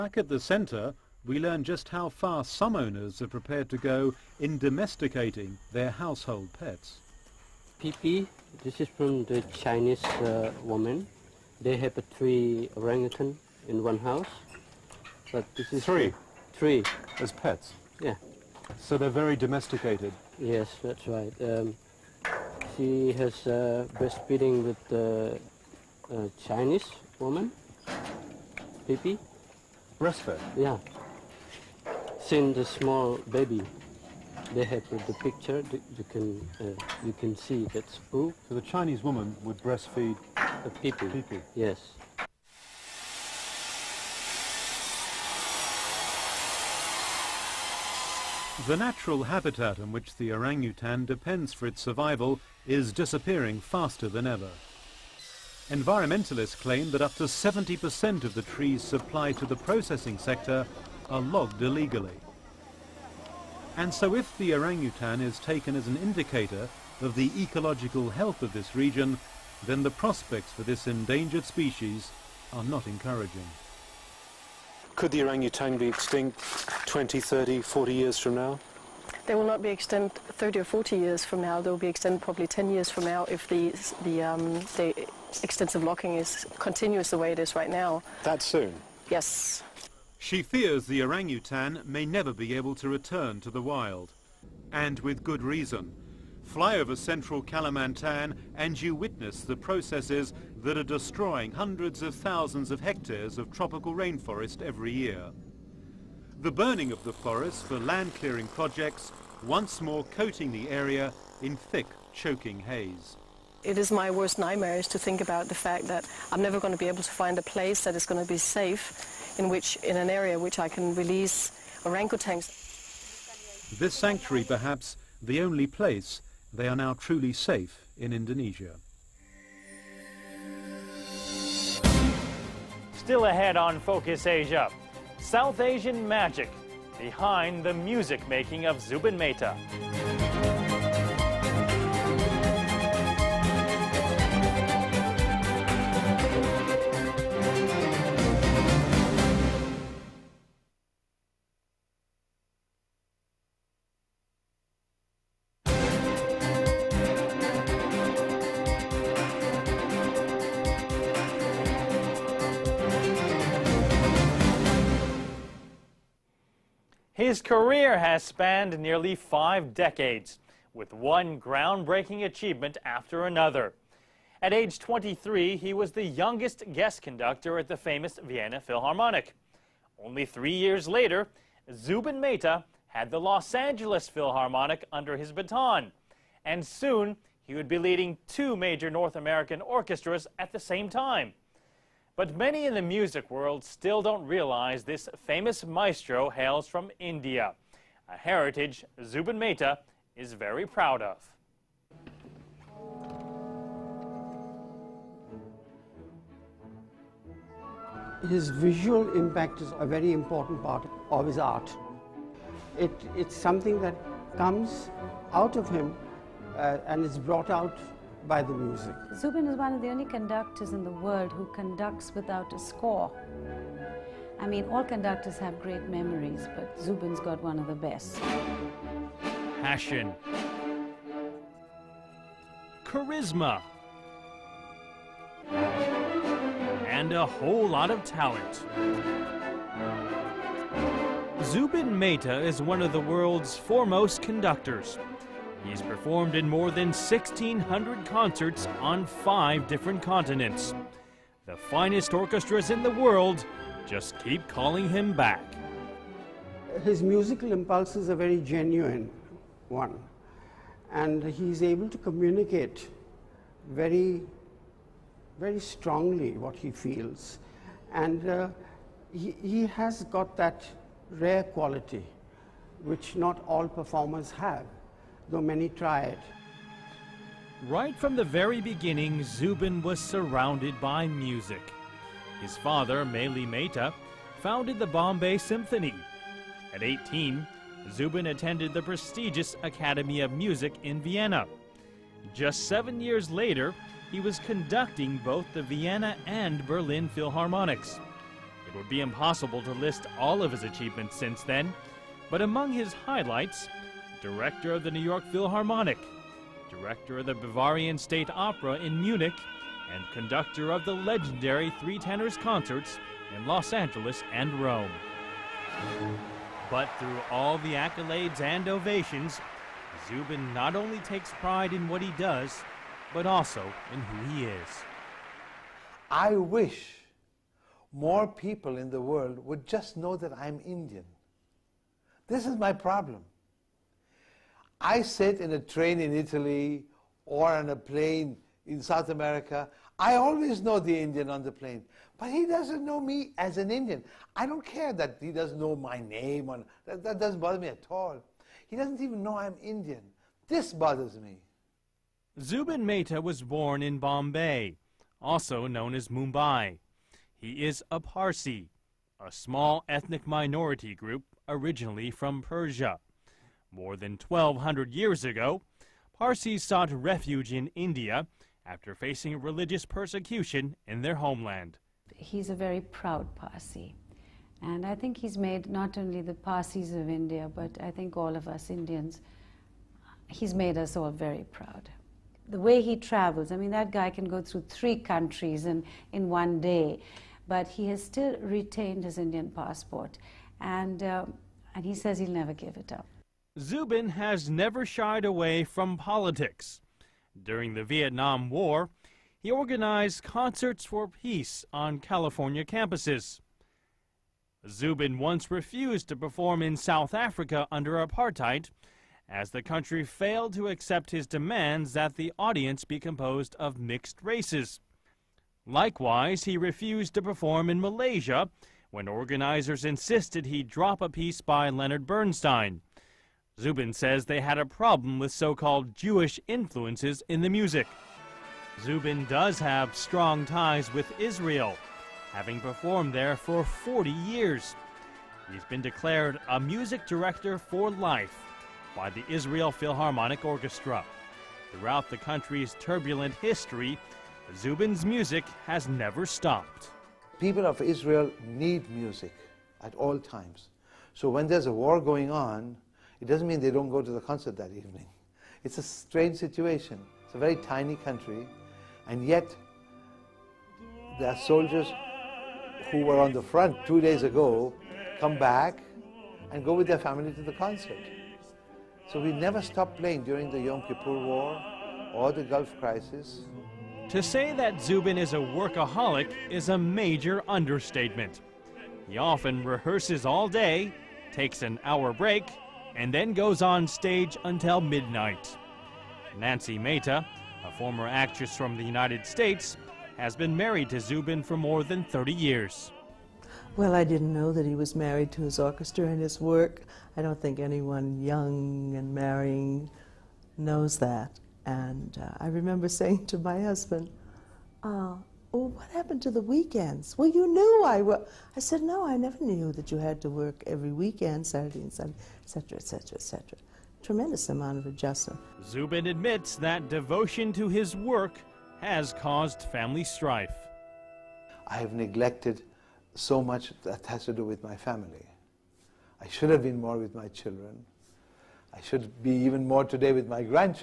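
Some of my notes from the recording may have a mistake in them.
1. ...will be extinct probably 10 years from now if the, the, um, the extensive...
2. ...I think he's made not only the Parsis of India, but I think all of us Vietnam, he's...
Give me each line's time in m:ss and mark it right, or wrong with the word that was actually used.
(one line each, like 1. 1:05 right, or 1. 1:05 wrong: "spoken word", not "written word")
1. 1:21 right
2. 6:14 wrong: "Indians", not "Vietnam".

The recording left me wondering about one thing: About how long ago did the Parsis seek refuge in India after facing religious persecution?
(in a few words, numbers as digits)
1,200 years ago.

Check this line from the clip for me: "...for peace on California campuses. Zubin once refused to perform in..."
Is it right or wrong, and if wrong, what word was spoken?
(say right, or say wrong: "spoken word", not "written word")
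right.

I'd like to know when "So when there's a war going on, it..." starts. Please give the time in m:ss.
7:31.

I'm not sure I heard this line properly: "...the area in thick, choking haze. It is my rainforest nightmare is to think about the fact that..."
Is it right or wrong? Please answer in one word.
wrong.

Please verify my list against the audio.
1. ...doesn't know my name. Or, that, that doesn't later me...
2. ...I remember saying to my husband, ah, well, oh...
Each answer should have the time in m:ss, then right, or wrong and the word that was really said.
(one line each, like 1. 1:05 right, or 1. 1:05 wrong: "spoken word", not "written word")
1. 5:45 wrong: "bother", not "later"
2. 8:22 right.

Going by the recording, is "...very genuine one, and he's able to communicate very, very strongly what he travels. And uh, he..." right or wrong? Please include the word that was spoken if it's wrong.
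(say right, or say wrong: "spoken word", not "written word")
wrong: "feels", not "travels".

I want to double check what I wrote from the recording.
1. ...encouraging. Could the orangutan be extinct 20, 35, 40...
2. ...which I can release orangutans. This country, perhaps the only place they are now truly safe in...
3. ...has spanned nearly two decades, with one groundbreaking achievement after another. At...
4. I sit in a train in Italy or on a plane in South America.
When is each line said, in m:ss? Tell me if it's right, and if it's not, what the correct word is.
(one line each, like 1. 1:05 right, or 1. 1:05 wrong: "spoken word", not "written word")
1. 1:12 wrong: "30", not "35"
2. 2:00 wrong: "sanctuary", not "country"
3. 2:47 wrong: "five", not "two"
4. 5:34 right.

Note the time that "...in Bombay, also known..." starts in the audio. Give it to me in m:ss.
5:53.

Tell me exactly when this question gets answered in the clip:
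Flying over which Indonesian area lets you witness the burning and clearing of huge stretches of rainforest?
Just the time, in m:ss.
1:36.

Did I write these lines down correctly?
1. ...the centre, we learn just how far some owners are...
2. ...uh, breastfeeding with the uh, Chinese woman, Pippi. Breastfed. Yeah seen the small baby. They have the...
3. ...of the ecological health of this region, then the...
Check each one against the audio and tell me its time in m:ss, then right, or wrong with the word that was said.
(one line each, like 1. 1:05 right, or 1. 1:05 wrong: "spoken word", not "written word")
1. 0:00 right
2. 0:23 right
3. 1:07 right.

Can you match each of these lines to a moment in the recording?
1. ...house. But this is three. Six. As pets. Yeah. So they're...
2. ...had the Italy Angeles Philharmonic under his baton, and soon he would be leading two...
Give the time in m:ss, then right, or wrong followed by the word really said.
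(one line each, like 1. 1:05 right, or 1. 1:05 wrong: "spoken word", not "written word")
1. 0:13 wrong: "Three", not "Six"
2. 3:02 wrong: "Los", not "Italy".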